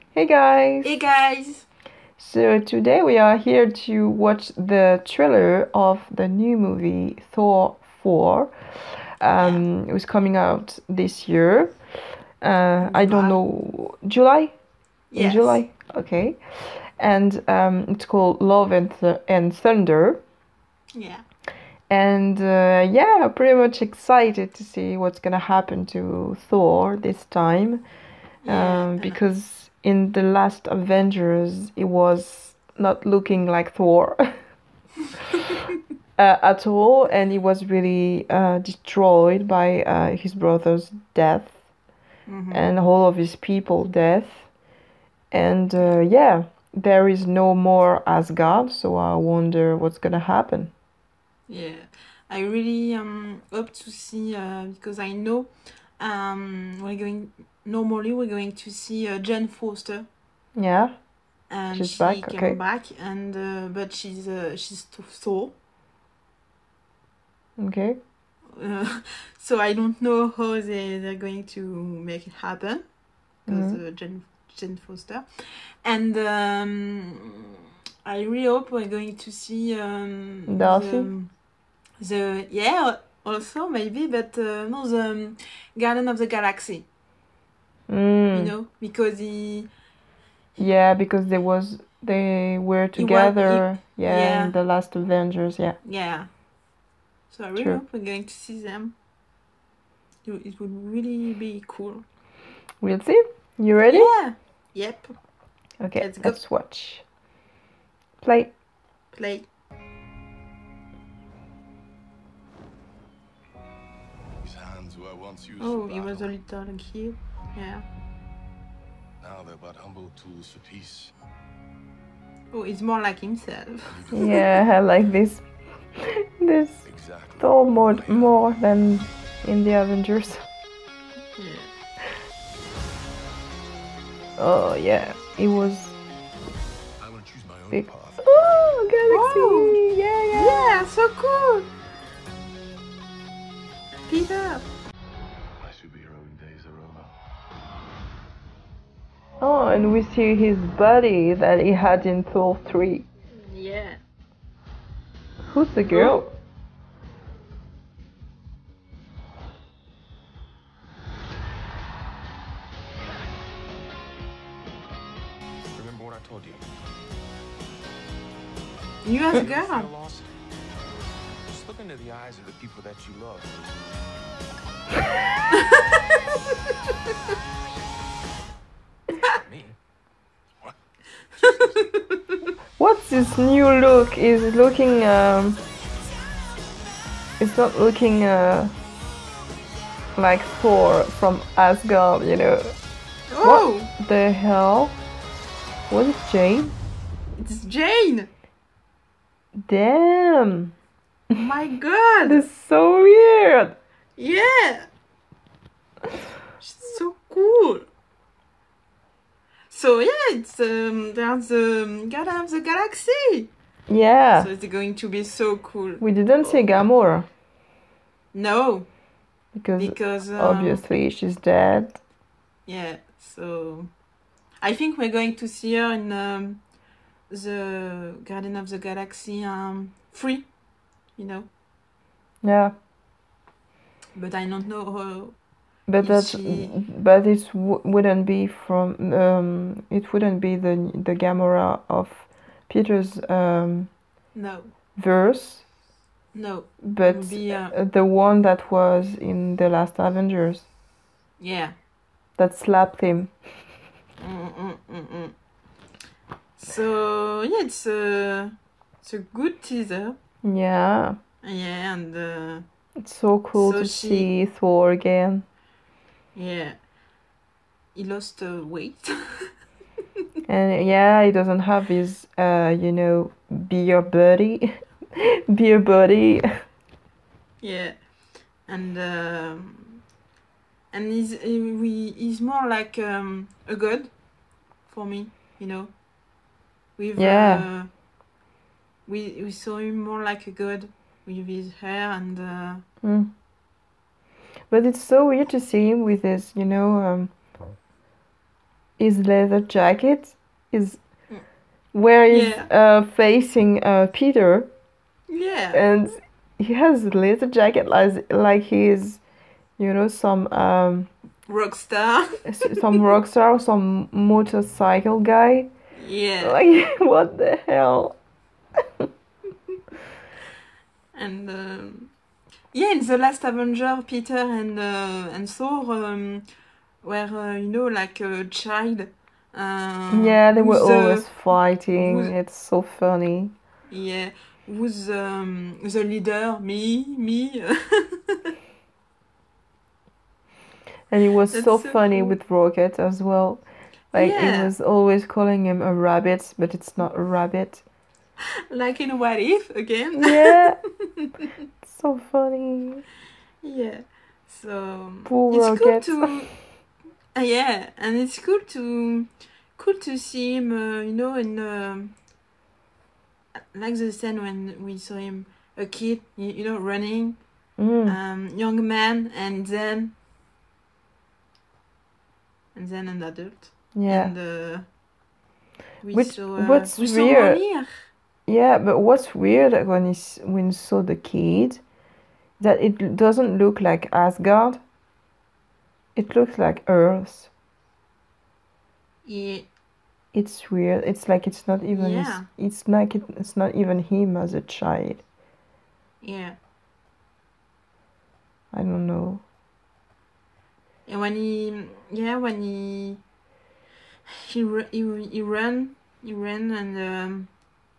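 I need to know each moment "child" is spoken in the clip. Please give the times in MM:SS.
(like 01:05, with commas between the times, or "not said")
05:28, 06:34.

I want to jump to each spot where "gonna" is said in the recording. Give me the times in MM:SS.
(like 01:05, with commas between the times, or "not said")
00:25, 00:49.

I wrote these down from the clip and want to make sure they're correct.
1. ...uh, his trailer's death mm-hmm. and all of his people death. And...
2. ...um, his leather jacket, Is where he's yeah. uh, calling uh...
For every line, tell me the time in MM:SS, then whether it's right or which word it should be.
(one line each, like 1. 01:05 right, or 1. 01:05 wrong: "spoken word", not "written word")
1. 00:39 wrong: "brother", not "trailer"
2. 04:56 wrong: "facing", not "calling".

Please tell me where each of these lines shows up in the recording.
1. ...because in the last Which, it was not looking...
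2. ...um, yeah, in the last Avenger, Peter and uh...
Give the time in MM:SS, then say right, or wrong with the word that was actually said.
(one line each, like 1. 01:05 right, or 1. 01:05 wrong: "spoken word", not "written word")
1. 00:28 wrong: "Avengers", not "Which"
2. 05:21 right.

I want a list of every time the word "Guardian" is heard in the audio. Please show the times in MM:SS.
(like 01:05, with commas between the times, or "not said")
01:25, 03:32, 03:48.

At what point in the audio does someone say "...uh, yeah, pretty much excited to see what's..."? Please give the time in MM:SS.
00:22.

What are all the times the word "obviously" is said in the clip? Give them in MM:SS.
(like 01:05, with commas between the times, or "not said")
03:40.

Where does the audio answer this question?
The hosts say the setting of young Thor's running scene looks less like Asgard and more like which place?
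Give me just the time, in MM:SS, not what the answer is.
06:26.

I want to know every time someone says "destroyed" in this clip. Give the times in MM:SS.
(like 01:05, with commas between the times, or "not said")
00:38.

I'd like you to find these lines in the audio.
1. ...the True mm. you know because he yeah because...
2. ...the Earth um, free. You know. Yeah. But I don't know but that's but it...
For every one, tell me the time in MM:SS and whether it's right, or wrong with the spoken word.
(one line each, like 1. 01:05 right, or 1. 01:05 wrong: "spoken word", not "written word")
1. 01:26 wrong: "Galaxy", not "True"
2. 03:48 wrong: "Galaxy", not "Earth".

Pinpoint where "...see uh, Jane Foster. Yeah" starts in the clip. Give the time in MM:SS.
00:58.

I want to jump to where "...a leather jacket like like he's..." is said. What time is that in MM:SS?
05:07.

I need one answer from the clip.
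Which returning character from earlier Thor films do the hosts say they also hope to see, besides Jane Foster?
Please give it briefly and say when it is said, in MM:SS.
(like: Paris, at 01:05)
Darcy, at 01:20.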